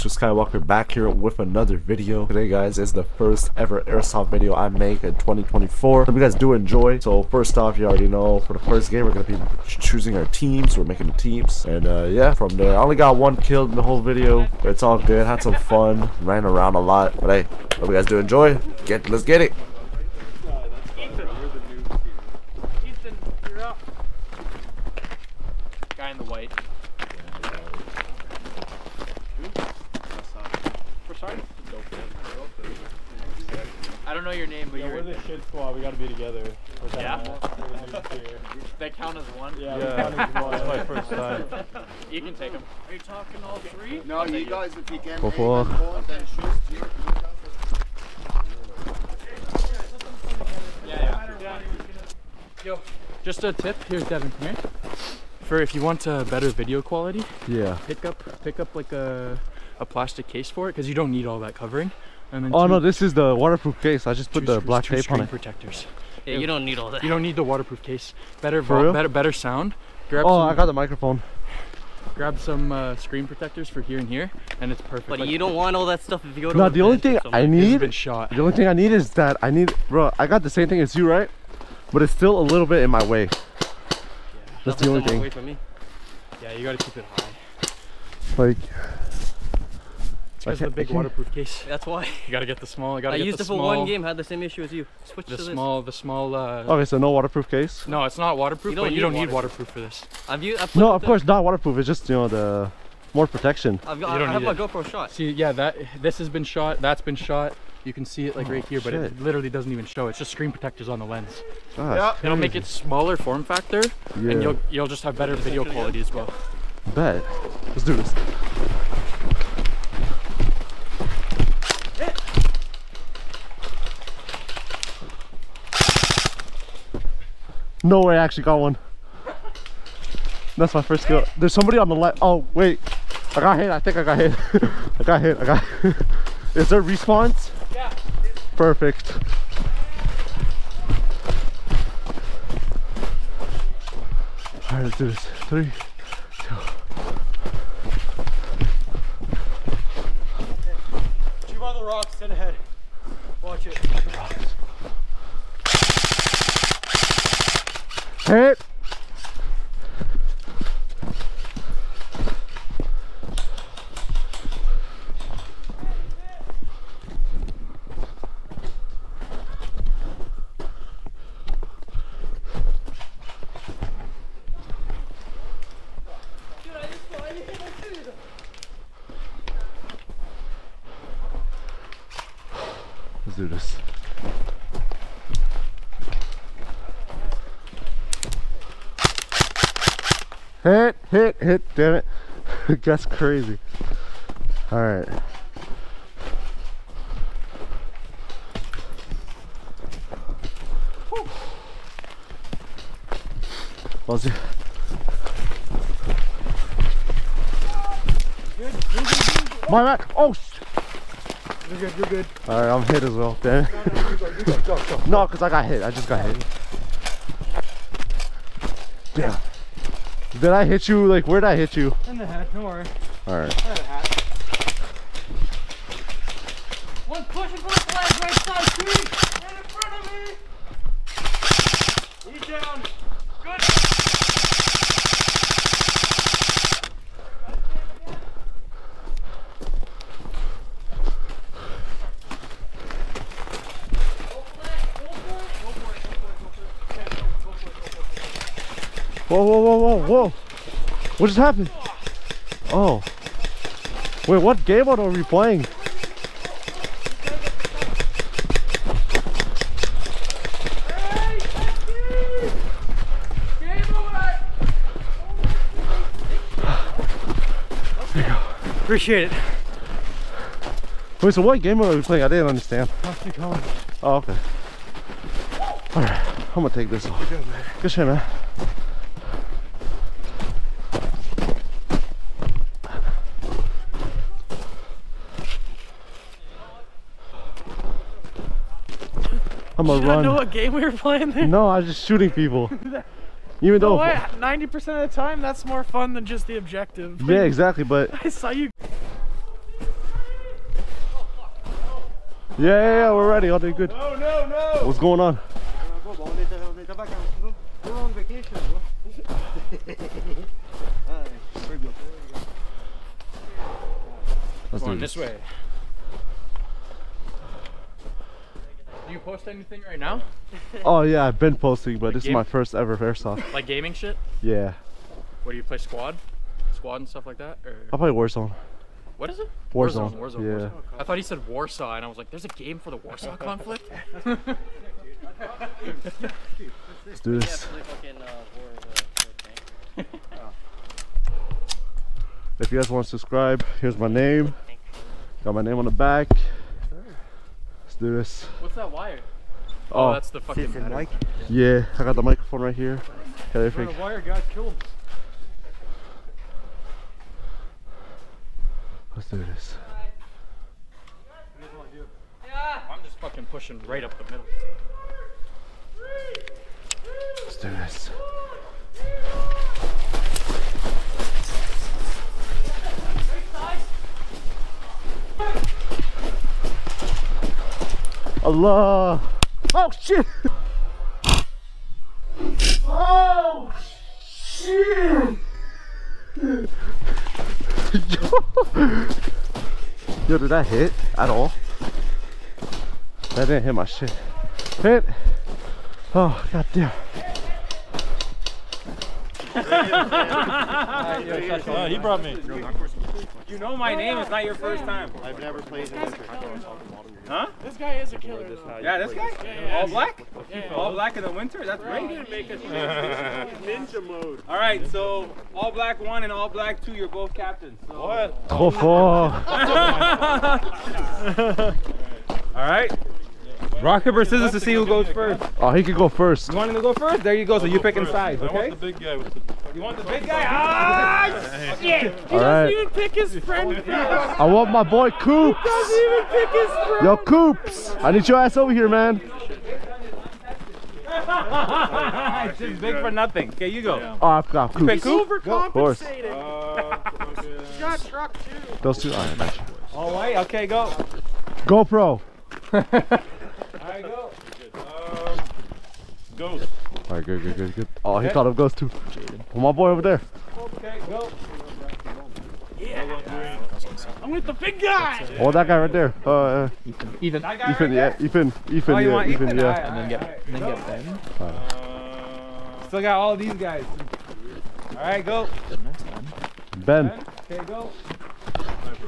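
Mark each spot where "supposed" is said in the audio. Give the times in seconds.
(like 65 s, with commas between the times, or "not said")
not said.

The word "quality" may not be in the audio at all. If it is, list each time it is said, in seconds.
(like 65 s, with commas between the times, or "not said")
56 s, 115 s.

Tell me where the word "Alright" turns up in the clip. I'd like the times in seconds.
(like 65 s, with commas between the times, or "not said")
194 s, 212 s, 223 s, 275 s, 457 s.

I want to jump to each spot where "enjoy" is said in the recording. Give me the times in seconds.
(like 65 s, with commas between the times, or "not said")
6 s, 18 s.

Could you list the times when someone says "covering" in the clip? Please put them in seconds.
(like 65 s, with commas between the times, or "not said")
61 s.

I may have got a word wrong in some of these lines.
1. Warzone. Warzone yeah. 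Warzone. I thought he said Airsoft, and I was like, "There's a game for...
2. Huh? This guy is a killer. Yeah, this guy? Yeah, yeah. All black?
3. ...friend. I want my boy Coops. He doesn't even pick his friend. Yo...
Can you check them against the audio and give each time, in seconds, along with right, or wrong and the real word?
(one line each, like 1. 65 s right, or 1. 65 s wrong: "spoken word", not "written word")
1. 330 s wrong: "Warsaw", not "Airsoft"
2. 407 s right
3. 433 s right.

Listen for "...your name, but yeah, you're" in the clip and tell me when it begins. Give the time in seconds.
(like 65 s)
34 s.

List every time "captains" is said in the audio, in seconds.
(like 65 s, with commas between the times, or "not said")
417 s.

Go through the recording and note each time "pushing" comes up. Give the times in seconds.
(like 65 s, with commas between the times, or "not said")
227 s, 363 s.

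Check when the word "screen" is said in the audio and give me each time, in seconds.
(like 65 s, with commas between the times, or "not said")
72 s, 110 s.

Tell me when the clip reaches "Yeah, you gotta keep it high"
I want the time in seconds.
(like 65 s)
86 s.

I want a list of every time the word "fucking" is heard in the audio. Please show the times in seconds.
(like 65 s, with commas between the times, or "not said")
350 s, 363 s.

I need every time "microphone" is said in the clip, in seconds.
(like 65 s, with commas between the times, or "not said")
70 s, 352 s.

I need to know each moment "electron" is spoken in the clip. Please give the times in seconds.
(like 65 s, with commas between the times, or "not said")
not said.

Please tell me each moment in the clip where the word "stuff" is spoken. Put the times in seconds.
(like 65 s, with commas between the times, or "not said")
76 s, 327 s.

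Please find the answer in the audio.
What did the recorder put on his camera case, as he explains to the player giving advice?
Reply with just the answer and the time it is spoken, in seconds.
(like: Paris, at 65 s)
Black tape, at 64 s.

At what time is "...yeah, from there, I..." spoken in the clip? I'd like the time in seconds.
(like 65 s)
12 s.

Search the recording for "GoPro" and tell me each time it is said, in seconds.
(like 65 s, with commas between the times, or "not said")
104 s, 451 s.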